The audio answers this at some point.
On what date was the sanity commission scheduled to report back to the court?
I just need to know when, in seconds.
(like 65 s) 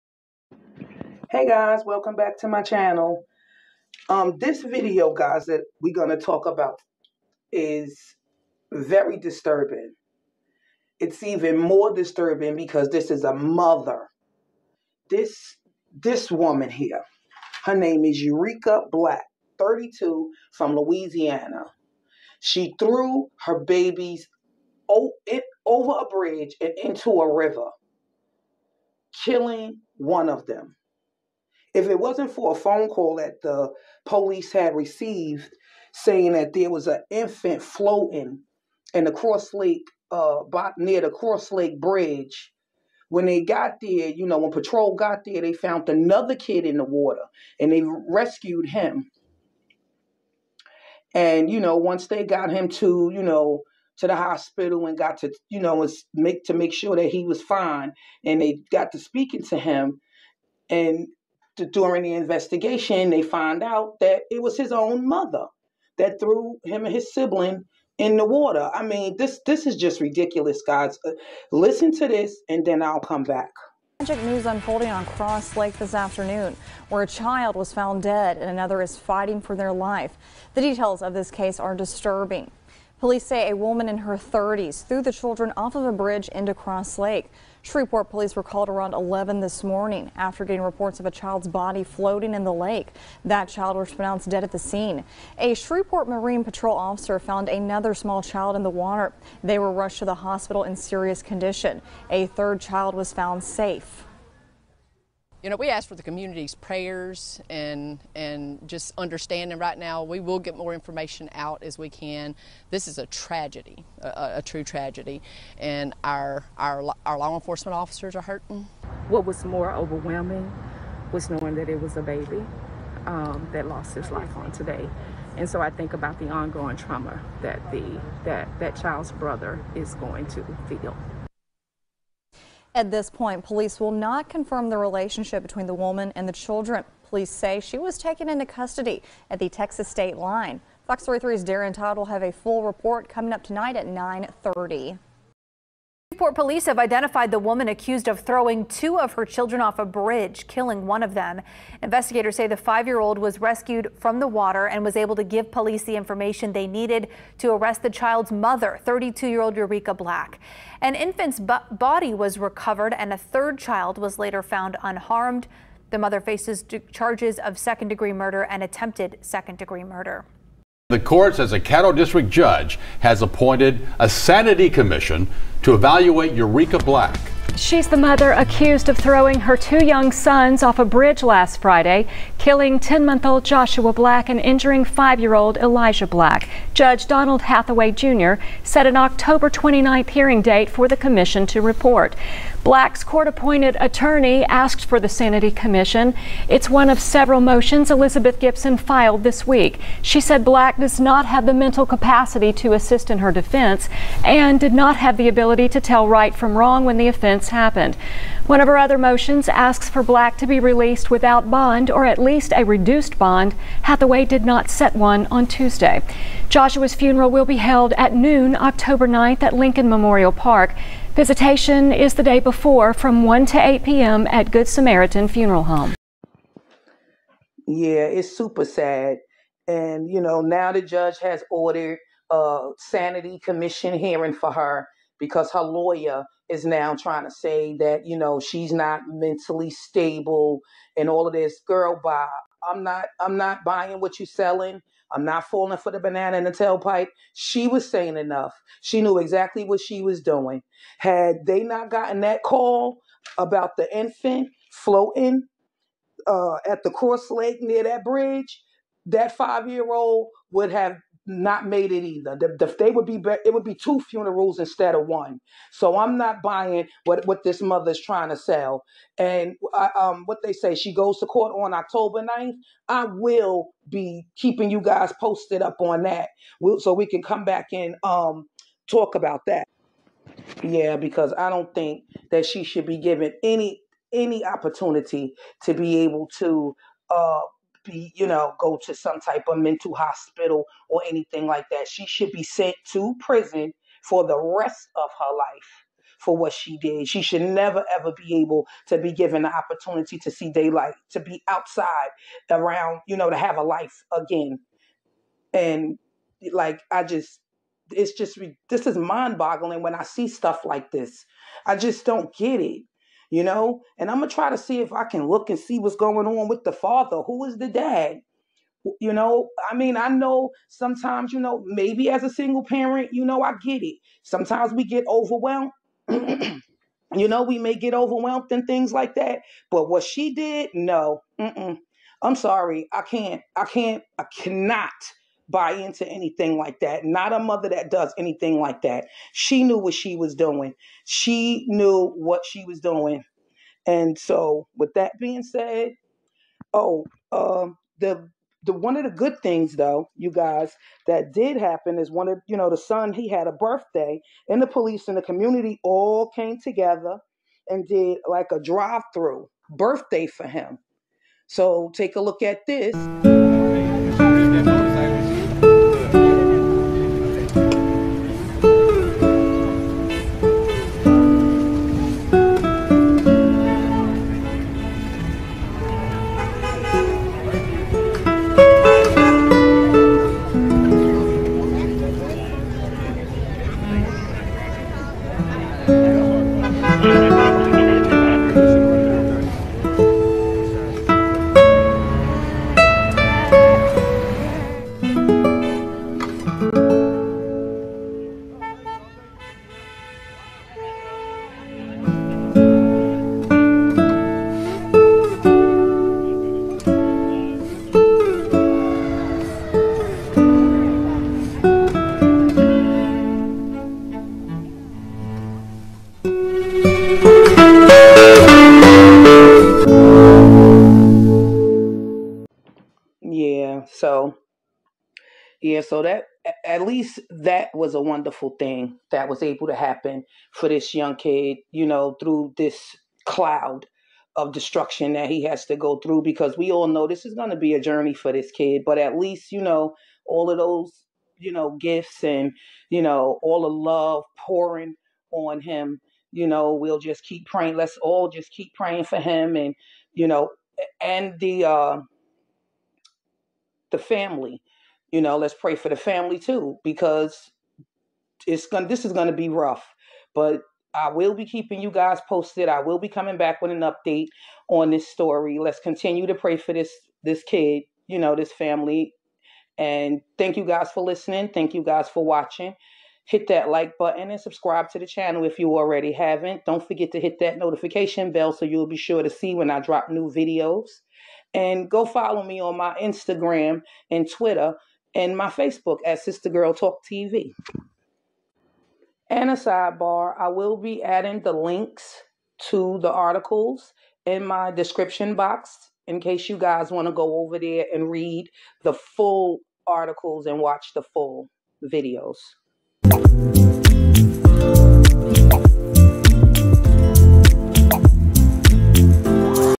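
188 s.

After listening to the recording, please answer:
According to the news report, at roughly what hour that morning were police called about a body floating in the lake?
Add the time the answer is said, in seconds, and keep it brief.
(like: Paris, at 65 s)
11, at 88 s.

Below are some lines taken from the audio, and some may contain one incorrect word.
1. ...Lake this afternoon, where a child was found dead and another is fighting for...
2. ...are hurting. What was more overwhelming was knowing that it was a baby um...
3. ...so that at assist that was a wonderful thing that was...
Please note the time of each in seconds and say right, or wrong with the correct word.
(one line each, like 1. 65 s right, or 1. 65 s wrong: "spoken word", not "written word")
1. 75 s right
2. 118 s right
3. 425 s wrong: "least", not "assist".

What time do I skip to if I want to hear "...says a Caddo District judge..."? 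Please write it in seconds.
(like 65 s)
171 s.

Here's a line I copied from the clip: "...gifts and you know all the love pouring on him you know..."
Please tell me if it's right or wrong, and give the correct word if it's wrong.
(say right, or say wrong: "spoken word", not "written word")
right.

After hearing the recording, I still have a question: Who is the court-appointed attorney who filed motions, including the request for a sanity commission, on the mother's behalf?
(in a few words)
Elizabeth Gibson.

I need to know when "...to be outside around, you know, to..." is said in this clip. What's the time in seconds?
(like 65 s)
301 s.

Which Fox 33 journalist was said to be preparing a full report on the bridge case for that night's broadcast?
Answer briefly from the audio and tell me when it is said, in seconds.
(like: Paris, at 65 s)
Darren Todd, at 141 s.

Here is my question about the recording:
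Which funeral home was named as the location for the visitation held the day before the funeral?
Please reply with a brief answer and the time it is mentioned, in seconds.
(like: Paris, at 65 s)
Good Samaritan Funeral Home, at 224 s.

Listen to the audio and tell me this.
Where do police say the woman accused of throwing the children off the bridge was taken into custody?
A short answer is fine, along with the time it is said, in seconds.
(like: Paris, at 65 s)
Texas state line, at 139 s.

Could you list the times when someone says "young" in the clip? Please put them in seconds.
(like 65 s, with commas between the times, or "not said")
179 s, 430 s.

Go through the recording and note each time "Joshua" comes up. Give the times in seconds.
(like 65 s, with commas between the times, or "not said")
183 s, 216 s.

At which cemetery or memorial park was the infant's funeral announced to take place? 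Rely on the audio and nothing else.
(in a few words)
Lincoln Memorial Park.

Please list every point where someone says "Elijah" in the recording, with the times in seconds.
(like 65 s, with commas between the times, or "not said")
185 s.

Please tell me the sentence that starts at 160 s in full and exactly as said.
An infant's body was recovered and a third child was later found unharmed.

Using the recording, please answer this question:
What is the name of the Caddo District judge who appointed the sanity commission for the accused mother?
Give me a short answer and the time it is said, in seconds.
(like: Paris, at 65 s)
Donald Hathaway Jr., at 187 s.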